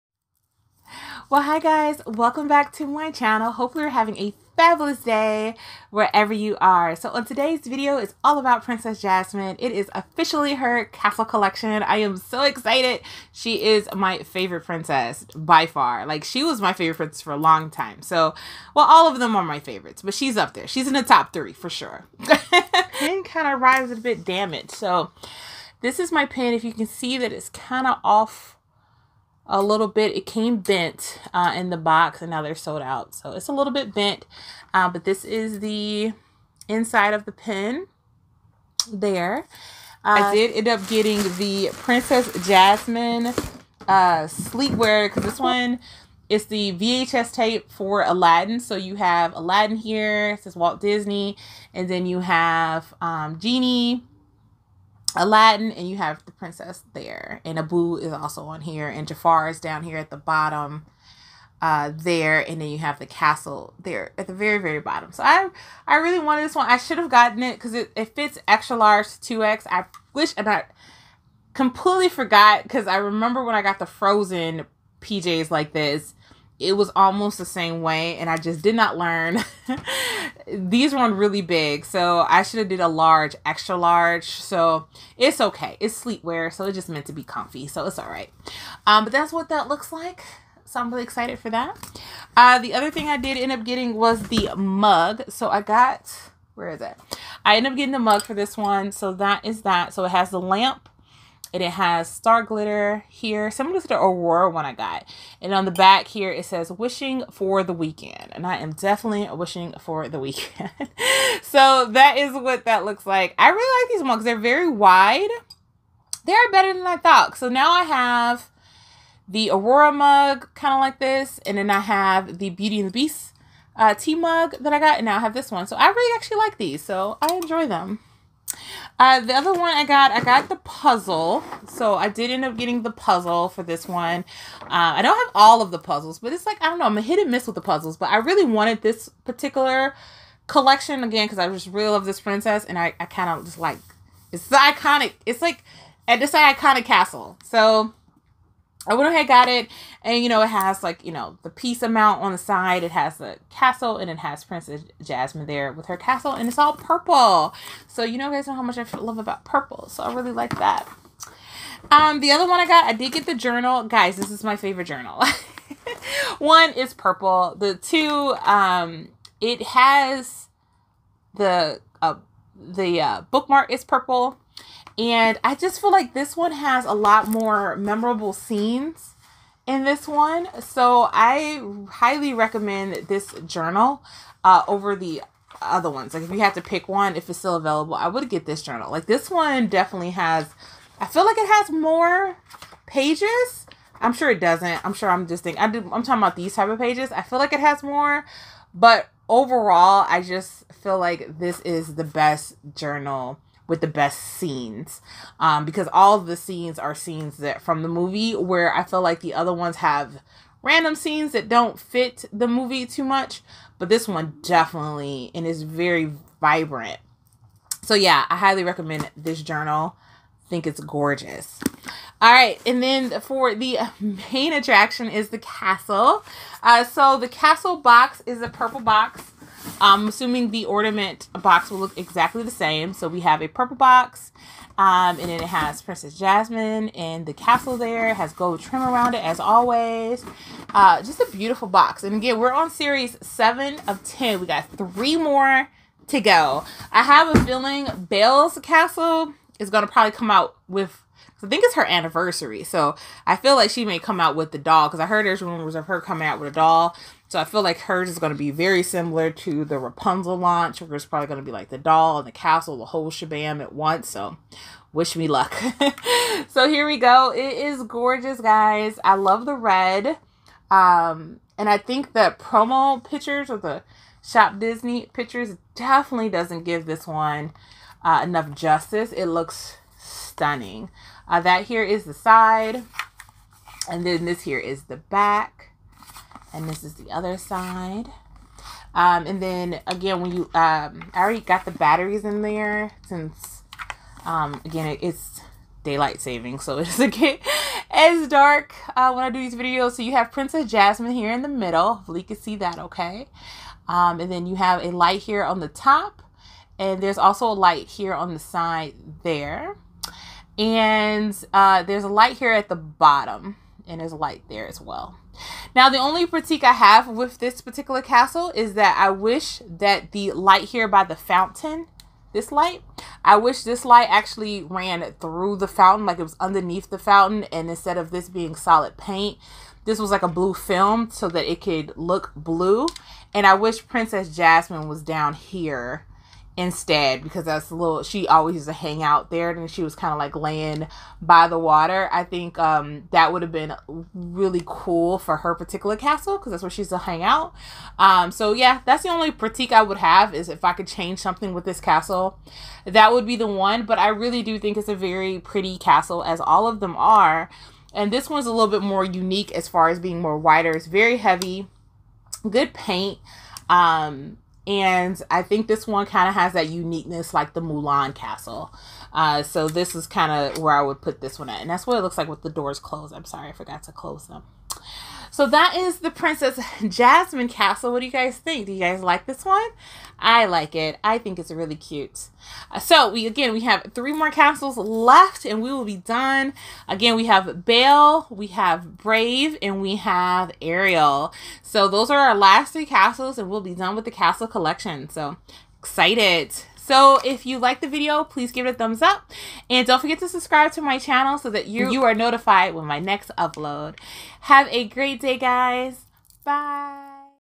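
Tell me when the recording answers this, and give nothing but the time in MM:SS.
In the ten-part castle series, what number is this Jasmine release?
04:03.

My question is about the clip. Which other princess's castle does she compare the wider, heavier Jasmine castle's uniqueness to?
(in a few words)
Mulan.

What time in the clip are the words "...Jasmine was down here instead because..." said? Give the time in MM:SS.
05:34.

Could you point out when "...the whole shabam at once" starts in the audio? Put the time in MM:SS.
04:22.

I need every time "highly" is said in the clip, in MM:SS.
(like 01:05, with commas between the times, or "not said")
03:01, 03:38.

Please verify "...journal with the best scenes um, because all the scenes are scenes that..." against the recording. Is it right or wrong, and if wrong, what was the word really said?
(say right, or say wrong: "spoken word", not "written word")
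right.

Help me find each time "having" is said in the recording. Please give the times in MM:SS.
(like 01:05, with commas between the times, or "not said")
00:03.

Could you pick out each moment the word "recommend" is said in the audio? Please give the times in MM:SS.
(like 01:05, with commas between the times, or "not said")
03:02, 03:38.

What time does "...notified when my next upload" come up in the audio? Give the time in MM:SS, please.
06:42.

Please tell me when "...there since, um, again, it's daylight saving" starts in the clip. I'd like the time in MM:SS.
04:52.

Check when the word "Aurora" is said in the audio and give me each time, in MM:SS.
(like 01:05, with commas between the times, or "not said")
01:43, 01:59.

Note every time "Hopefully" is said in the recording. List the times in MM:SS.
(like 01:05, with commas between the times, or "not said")
00:03, 05:01.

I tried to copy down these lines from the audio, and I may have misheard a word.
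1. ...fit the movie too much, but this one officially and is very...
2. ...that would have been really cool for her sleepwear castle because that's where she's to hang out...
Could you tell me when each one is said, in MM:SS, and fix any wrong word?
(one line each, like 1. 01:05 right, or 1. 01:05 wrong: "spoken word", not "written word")
1. 03:31 wrong: "definitely", not "officially"
2. 05:43 wrong: "particular", not "sleepwear".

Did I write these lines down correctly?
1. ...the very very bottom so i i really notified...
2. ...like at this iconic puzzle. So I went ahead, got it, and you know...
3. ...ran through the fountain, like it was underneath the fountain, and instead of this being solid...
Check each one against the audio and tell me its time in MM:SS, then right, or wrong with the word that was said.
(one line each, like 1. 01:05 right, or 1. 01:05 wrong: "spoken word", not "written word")
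1. 01:04 wrong: "wanted", not "notified"
2. 02:25 wrong: "castle", not "puzzle"
3. 05:24 right.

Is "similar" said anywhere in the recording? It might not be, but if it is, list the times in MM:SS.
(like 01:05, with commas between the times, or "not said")
01:43, 04:18.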